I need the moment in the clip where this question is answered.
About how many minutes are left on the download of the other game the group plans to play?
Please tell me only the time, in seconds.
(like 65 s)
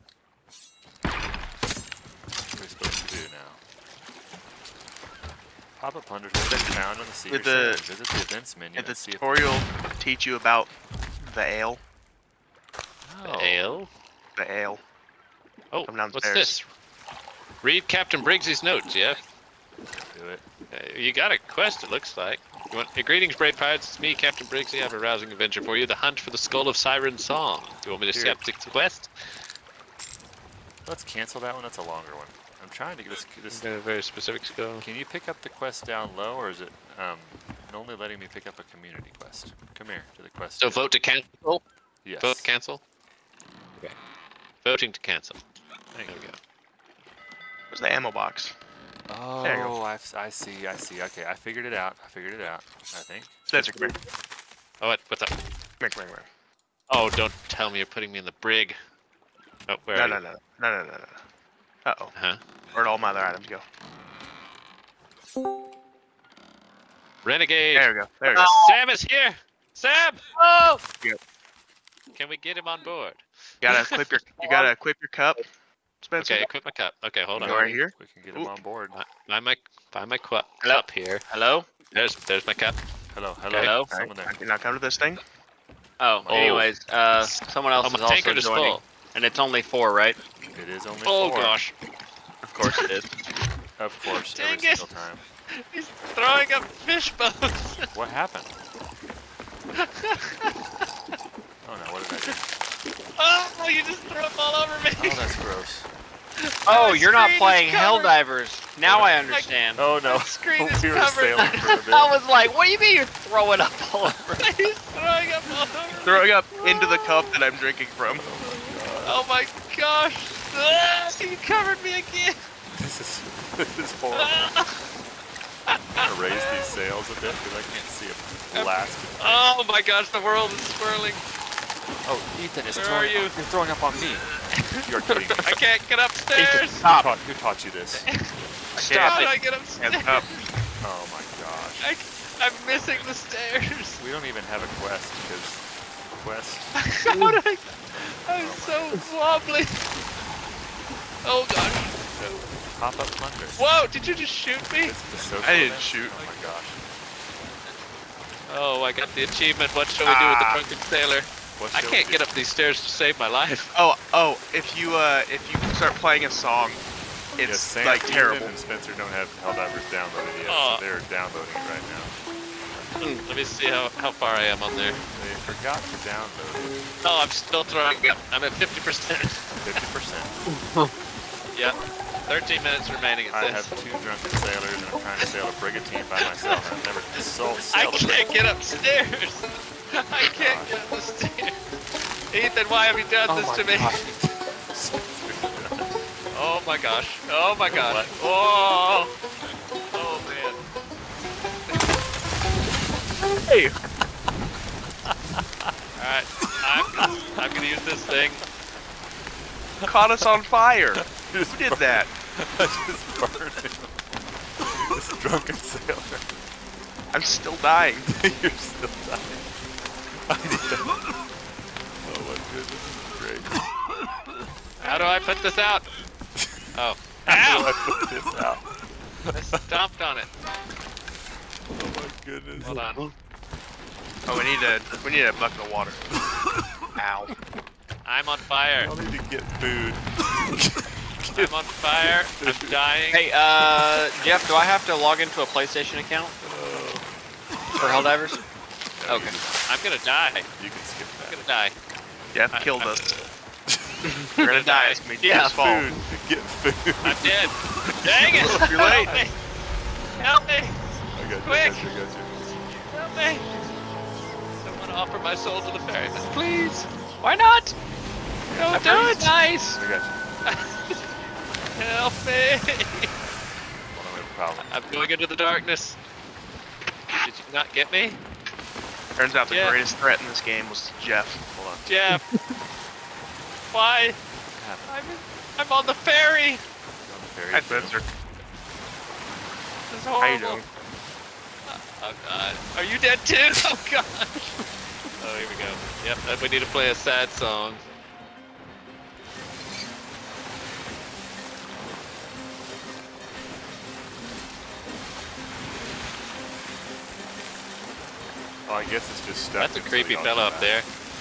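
182 s.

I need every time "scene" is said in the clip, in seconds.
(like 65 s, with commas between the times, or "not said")
not said.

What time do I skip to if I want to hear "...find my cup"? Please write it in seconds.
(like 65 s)
79 s.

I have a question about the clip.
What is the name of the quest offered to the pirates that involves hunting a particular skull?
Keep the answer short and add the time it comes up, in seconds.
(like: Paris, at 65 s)
Skull of Siren Song, at 26 s.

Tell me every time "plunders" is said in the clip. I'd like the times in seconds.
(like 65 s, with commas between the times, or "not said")
6 s, 153 s.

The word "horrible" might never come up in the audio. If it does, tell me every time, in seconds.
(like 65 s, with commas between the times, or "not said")
123 s, 290 s.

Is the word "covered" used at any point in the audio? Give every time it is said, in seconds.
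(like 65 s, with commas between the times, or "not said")
110 s, 121 s.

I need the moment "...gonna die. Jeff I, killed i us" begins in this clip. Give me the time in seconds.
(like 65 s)
251 s.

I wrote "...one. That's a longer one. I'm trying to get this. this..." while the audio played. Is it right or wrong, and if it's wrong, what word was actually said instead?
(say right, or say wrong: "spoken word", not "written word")
right.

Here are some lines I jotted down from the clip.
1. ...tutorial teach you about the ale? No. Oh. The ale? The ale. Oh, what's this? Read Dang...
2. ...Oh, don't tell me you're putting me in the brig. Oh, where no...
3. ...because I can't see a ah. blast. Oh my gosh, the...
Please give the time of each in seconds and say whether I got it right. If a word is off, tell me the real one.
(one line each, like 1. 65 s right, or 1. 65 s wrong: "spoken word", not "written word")
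1. 8 s wrong: "Captain", not "Dang"
2. 56 s right
3. 127 s right.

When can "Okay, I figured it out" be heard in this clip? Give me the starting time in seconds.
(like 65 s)
51 s.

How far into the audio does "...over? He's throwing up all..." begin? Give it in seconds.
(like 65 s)
114 s.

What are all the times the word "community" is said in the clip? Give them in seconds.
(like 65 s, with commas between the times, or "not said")
38 s.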